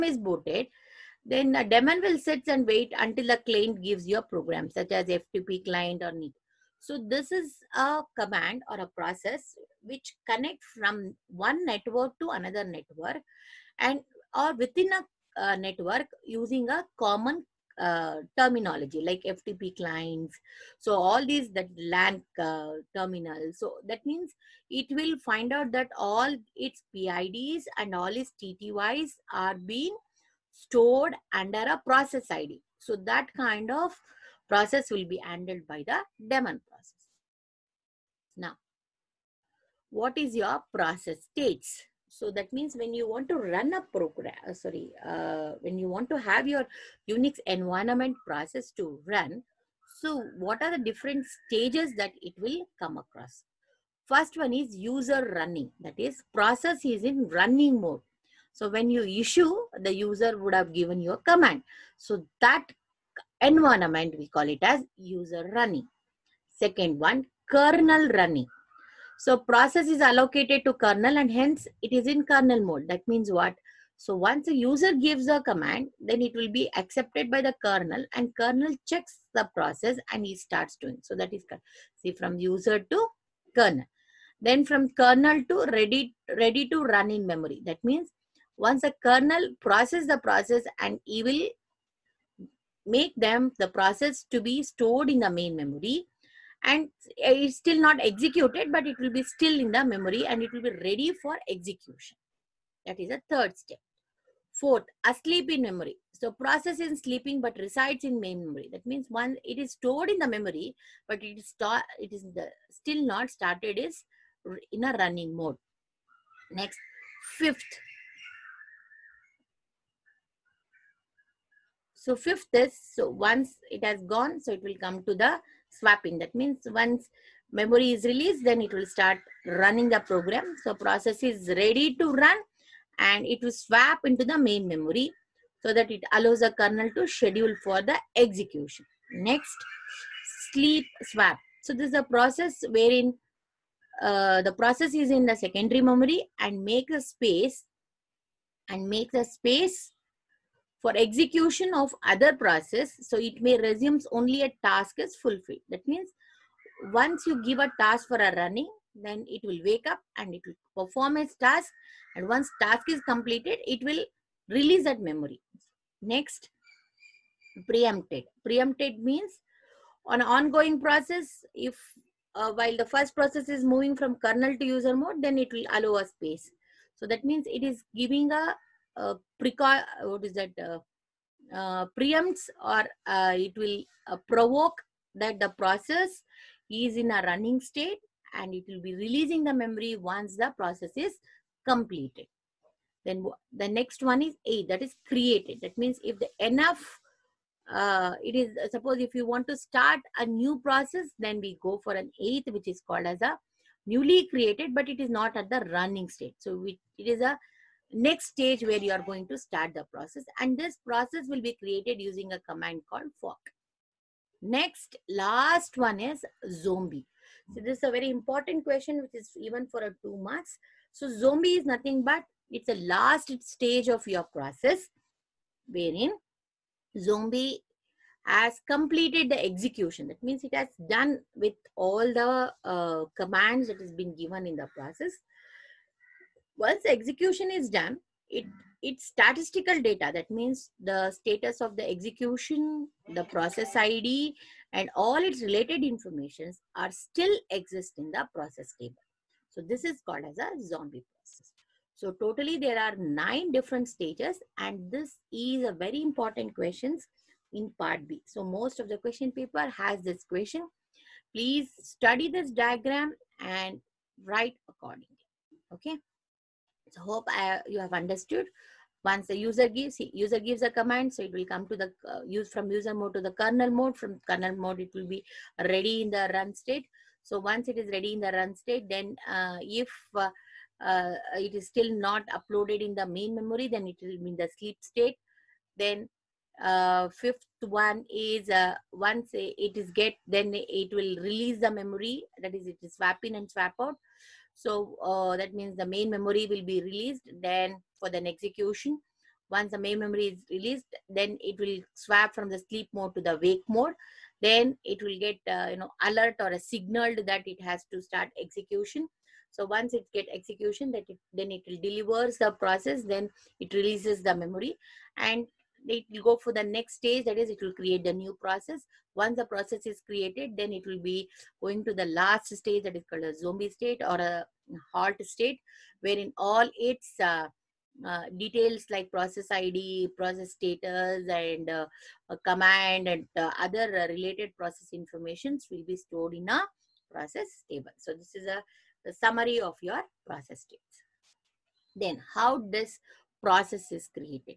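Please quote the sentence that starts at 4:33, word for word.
From kernel mode, it will be ready in the run state.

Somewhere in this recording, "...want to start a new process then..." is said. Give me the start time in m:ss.
3:19.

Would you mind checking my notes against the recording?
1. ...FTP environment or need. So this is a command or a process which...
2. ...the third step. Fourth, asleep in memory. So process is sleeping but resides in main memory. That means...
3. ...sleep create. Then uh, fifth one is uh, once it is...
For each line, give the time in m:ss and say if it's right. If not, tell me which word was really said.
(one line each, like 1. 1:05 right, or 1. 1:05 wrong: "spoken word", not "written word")
1. 0:05 wrong: "client", not "environment"
2. 1:43 right
3. 4:44 wrong: "state", not "create".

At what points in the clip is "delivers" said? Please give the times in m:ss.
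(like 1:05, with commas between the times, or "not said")
5:11.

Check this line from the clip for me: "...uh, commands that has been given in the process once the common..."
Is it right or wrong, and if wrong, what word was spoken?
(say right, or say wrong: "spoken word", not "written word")
wrong: "execution", not "common".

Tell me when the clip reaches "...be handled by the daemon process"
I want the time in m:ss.
0:35.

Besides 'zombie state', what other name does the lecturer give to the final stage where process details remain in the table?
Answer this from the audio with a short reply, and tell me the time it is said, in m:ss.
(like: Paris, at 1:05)
halt state, at 5:24.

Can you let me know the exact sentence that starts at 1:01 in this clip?
So that environment, we call it as user running.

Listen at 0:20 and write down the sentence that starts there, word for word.
So all these that LAN uh, terminals.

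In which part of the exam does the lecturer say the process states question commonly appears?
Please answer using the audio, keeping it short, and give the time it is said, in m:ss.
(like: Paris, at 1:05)
part b, at 4:17.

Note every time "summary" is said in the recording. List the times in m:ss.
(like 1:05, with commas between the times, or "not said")
5:39.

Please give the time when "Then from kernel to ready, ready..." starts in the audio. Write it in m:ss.
1:24.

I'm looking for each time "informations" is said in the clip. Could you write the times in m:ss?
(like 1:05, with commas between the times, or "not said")
4:05, 5:34.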